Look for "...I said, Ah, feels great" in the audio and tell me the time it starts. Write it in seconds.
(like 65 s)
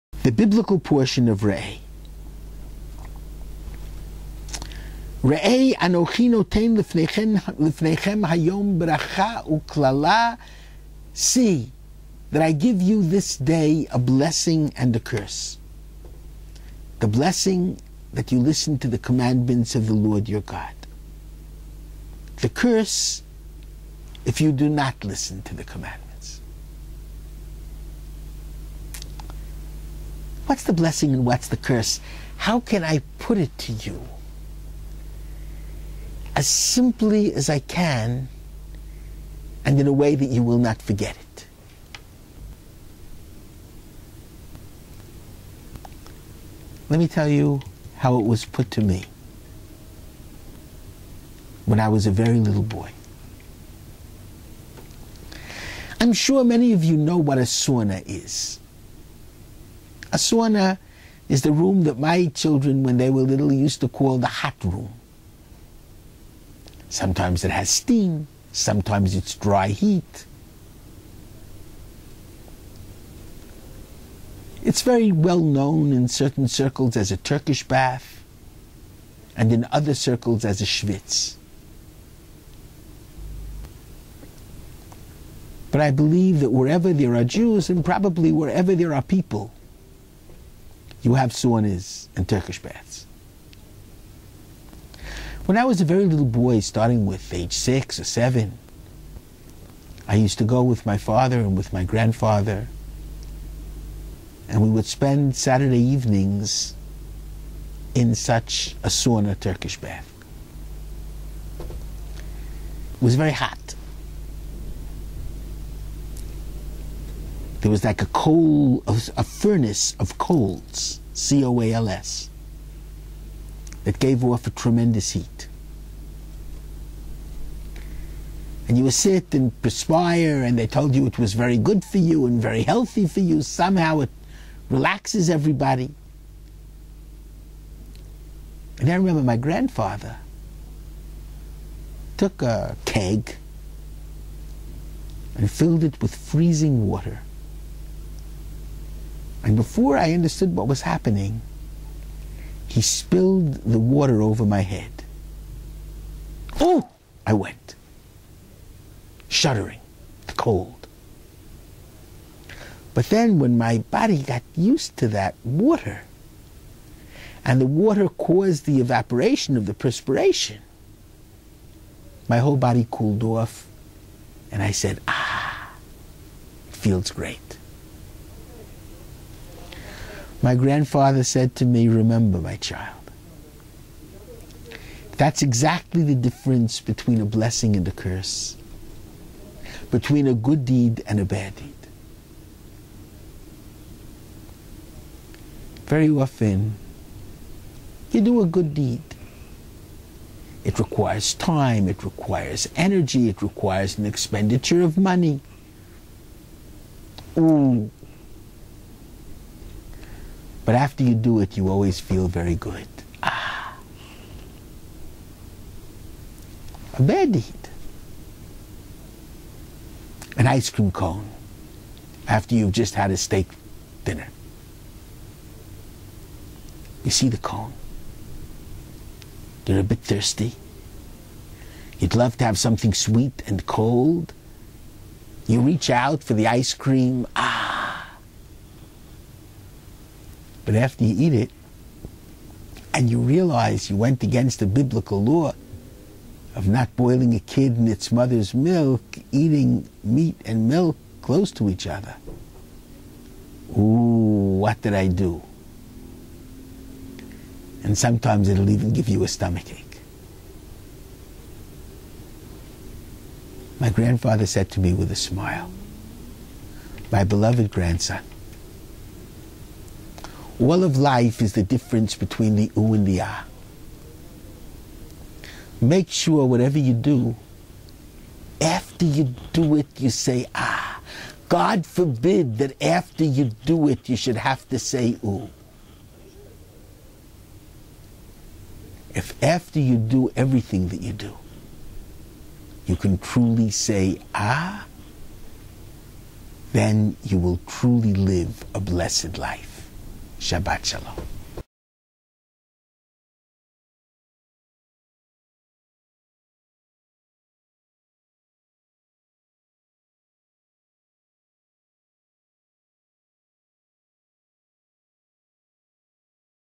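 174 s.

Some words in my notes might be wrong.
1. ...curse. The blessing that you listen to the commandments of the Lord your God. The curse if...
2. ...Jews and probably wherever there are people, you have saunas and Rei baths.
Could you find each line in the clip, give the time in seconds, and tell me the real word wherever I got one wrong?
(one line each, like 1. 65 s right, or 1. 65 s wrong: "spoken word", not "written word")
1. 14 s right
2. 87 s wrong: "Turkish", not "Rei".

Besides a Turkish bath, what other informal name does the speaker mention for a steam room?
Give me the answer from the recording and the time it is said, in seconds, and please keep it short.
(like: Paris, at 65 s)
schwitz, at 80 s.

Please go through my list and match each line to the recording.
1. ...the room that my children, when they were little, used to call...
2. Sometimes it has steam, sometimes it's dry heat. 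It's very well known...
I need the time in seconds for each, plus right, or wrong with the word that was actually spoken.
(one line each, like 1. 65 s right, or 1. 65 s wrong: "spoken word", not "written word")
1. 61 s right
2. 66 s right.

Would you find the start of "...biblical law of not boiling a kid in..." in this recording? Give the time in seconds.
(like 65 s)
244 s.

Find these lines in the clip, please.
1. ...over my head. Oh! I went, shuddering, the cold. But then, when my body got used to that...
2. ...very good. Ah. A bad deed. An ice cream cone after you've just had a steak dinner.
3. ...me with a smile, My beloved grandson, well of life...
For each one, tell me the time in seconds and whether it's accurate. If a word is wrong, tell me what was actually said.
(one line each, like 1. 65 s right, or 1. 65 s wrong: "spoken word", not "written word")
1. 154 s right
2. 212 s right
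3. 264 s right.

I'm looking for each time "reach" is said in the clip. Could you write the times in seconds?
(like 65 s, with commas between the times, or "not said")
235 s.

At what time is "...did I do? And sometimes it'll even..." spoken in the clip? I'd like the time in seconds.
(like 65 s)
254 s.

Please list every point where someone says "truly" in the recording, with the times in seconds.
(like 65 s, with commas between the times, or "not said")
293 s, 297 s.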